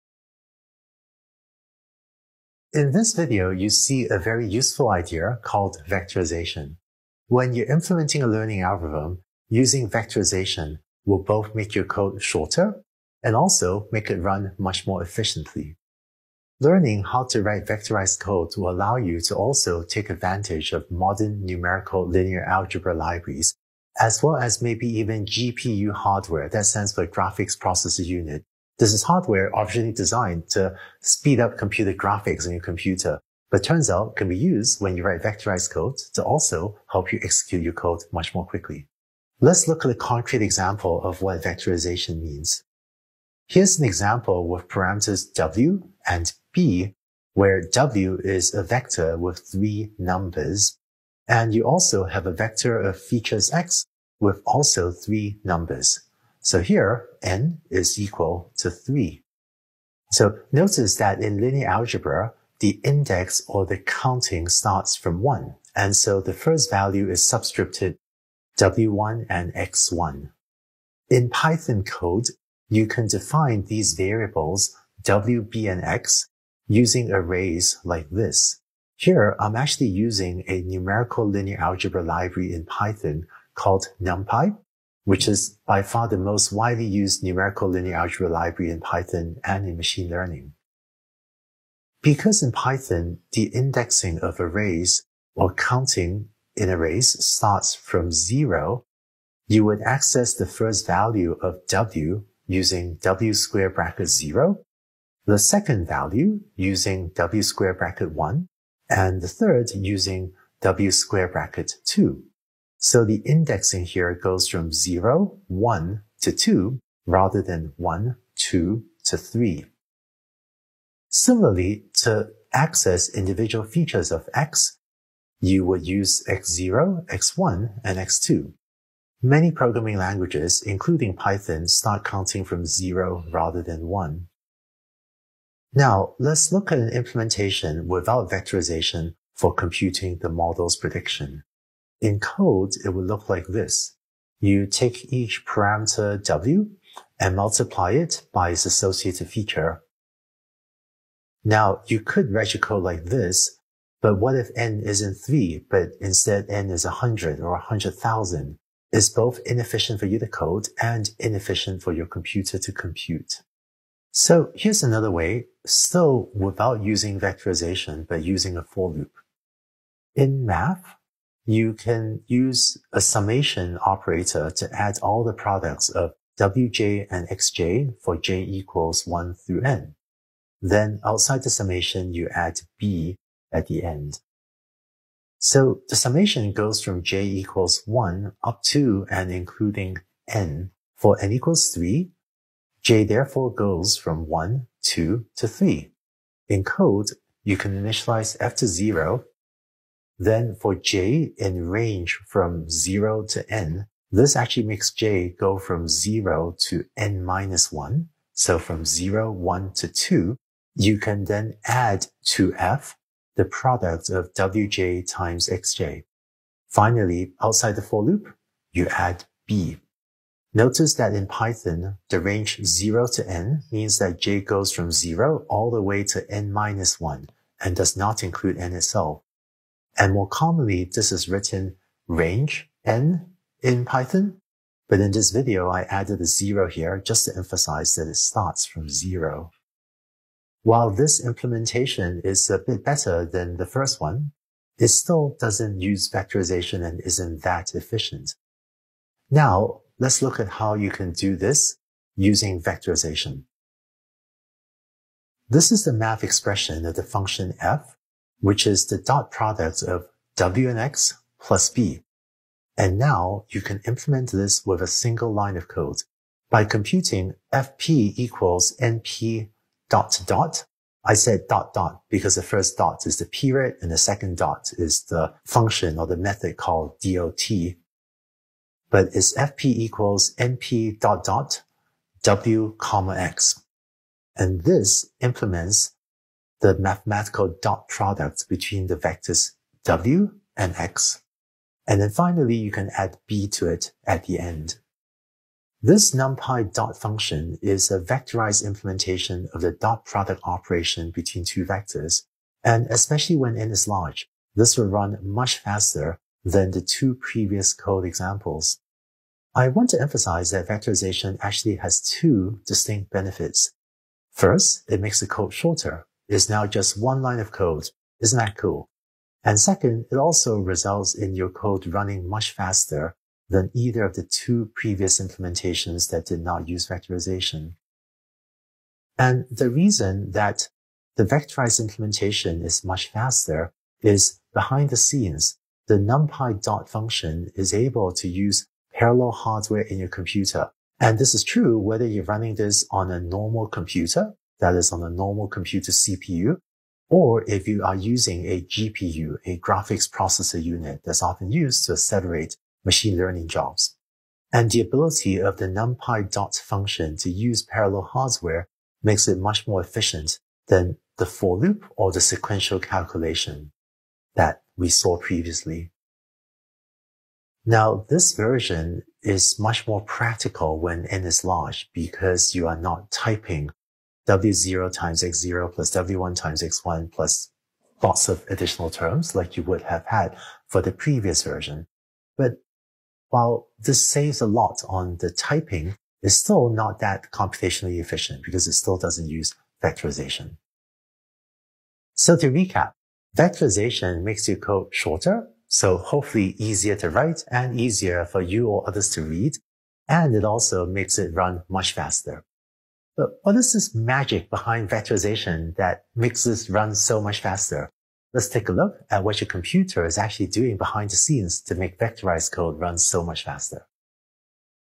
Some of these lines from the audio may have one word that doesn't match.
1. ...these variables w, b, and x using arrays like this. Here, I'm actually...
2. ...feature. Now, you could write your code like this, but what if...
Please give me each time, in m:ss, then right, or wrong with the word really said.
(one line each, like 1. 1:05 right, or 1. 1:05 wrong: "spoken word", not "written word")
1. 1:13 right
2. 2:29 right.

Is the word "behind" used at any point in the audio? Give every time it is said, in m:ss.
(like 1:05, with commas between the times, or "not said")
5:34, 6:44, 6:50.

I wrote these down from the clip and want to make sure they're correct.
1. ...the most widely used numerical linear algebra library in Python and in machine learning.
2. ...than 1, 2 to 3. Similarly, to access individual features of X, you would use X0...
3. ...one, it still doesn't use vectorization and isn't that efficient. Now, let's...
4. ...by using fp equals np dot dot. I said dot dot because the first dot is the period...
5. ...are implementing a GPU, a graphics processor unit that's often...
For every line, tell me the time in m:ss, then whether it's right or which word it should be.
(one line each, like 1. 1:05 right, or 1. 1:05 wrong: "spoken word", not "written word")
1. 1:26 right
2. 1:57 right
3. 4:04 right
4. 4:26 wrong: "computing", not "using"
5. 5:47 wrong: "using", not "implementing".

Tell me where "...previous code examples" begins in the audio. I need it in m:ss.
5:07.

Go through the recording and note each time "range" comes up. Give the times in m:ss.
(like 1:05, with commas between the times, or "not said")
3:21, 3:42, 3:52.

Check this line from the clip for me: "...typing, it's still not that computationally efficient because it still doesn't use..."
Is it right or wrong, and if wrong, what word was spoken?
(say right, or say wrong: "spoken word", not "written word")
right.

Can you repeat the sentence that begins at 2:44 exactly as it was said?
So here's another way, still without using vectorization, but using a for loop.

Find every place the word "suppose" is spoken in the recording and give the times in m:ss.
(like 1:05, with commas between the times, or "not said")
not said.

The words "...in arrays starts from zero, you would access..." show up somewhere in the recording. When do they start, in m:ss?
1:36.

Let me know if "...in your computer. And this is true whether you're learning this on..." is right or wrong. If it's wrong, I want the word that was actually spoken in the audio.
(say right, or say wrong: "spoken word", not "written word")
wrong: "running", not "learning".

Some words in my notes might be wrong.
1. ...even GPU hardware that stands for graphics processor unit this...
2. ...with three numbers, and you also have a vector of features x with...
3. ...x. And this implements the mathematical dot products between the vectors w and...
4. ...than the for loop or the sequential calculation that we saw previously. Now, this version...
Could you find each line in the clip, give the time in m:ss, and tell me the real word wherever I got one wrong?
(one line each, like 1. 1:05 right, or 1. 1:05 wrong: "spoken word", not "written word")
1. 0:24 right
2. 0:49 right
3. 4:43 right
4. 6:00 right.